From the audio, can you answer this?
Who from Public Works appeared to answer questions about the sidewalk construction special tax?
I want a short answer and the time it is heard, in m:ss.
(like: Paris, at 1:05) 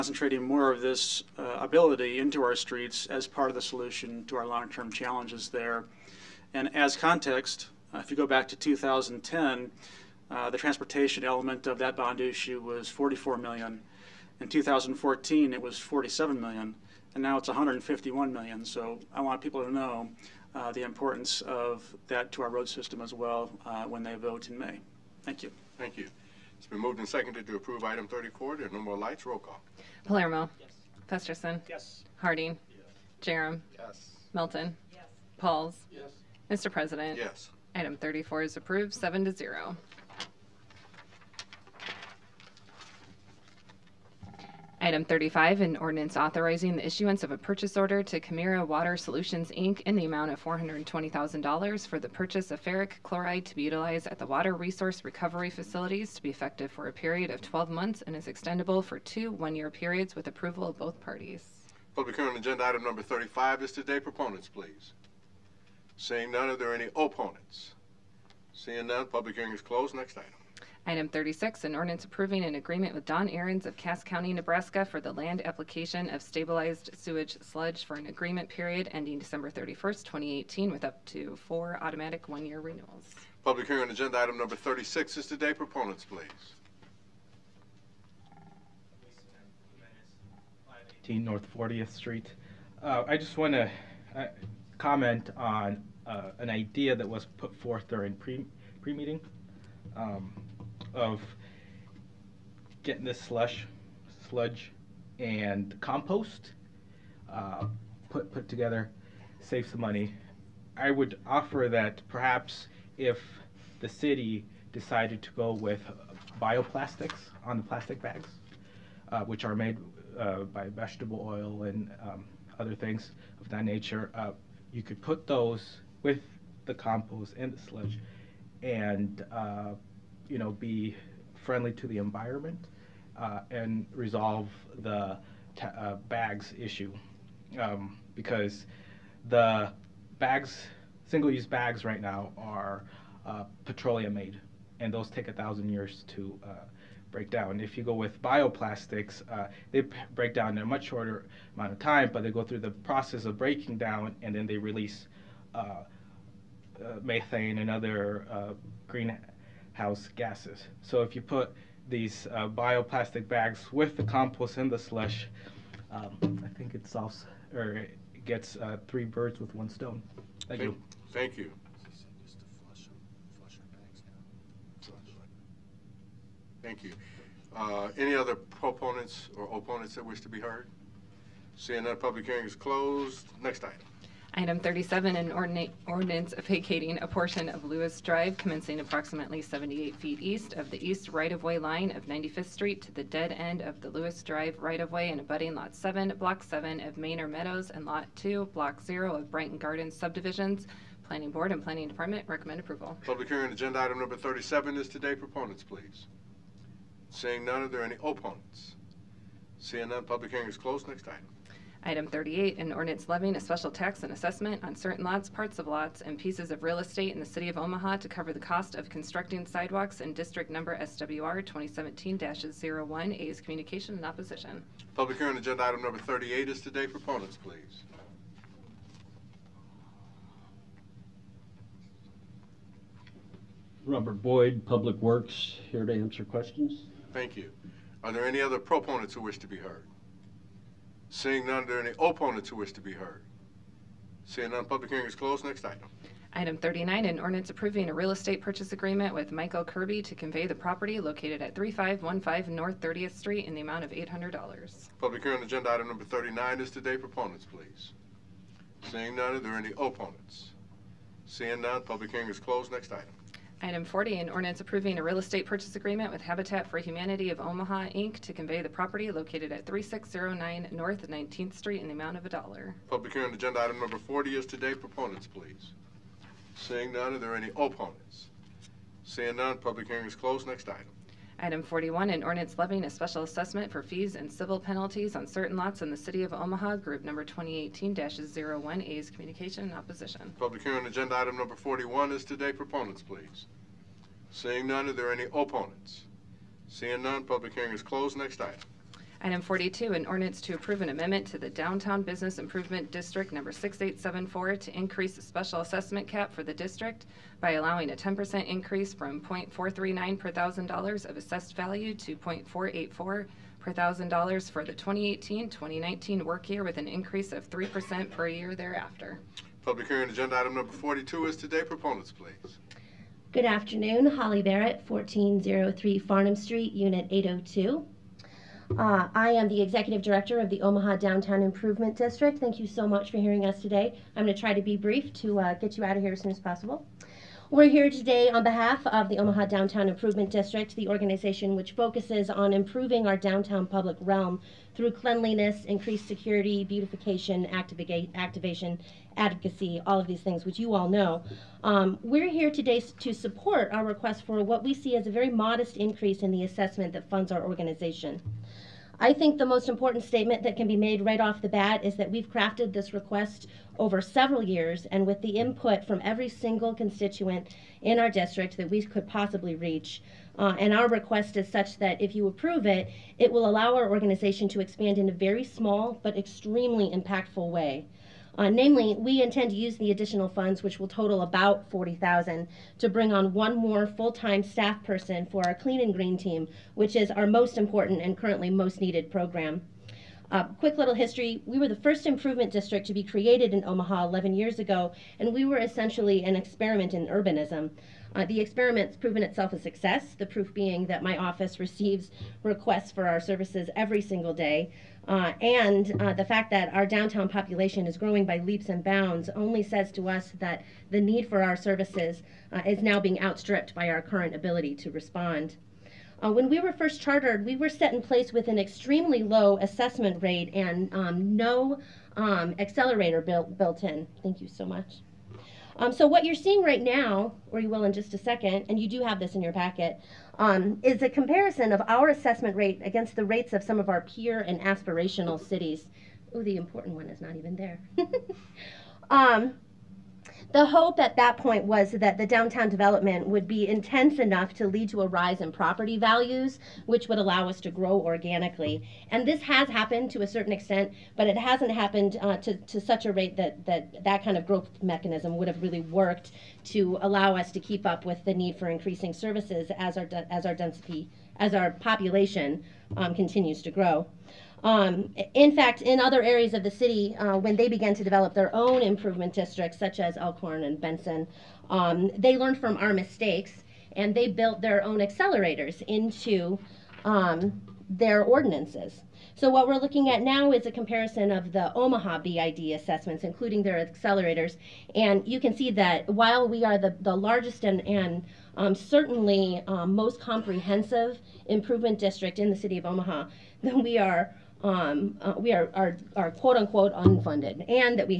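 Robert Boyd, at 3:53.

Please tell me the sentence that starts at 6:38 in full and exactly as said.
Uh, the experiment's proven itself a success, the proof being that my office receives requests for our services every single day.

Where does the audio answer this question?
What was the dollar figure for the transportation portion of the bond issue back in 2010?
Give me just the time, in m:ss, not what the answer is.
0:12.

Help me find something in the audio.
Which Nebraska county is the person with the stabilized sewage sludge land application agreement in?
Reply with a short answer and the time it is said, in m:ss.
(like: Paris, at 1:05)
Cass County, at 1:13.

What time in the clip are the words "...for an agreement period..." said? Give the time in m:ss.
1:17.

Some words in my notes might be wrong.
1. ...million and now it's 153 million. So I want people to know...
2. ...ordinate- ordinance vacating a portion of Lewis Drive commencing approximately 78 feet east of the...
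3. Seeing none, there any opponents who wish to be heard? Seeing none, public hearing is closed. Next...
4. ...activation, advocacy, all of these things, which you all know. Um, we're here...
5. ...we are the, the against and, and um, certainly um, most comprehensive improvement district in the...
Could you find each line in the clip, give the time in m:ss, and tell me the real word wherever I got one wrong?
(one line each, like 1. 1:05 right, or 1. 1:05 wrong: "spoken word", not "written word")
1. 0:16 wrong: "151", not "153"
2. 3:05 right
3. 4:01 right
4. 5:47 right
5. 8:06 wrong: "largest", not "against".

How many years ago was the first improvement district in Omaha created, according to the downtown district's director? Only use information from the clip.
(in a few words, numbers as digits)
11.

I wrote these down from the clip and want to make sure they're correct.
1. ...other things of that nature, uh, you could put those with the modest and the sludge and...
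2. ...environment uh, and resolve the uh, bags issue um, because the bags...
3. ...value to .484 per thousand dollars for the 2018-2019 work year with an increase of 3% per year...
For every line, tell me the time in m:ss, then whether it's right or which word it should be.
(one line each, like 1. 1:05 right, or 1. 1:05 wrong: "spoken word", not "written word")
1. 2:02 wrong: "compost", not "modest"
2. 2:11 right
3. 5:11 right.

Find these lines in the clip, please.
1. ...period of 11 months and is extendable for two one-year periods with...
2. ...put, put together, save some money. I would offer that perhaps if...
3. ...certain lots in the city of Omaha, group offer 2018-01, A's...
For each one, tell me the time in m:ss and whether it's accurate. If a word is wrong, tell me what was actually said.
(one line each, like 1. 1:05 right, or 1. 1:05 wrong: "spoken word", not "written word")
1. 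0:56 wrong: "12", not "11"
2. 1:48 right
3. 4:45 wrong: "number", not "offer".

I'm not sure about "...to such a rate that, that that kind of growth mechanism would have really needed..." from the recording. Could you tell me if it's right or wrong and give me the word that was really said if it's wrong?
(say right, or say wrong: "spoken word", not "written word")
wrong: "worked", not "needed".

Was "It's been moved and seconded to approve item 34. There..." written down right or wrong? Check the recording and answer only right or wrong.
right.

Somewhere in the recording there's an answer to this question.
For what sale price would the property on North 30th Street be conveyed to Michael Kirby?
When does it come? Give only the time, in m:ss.
4:13.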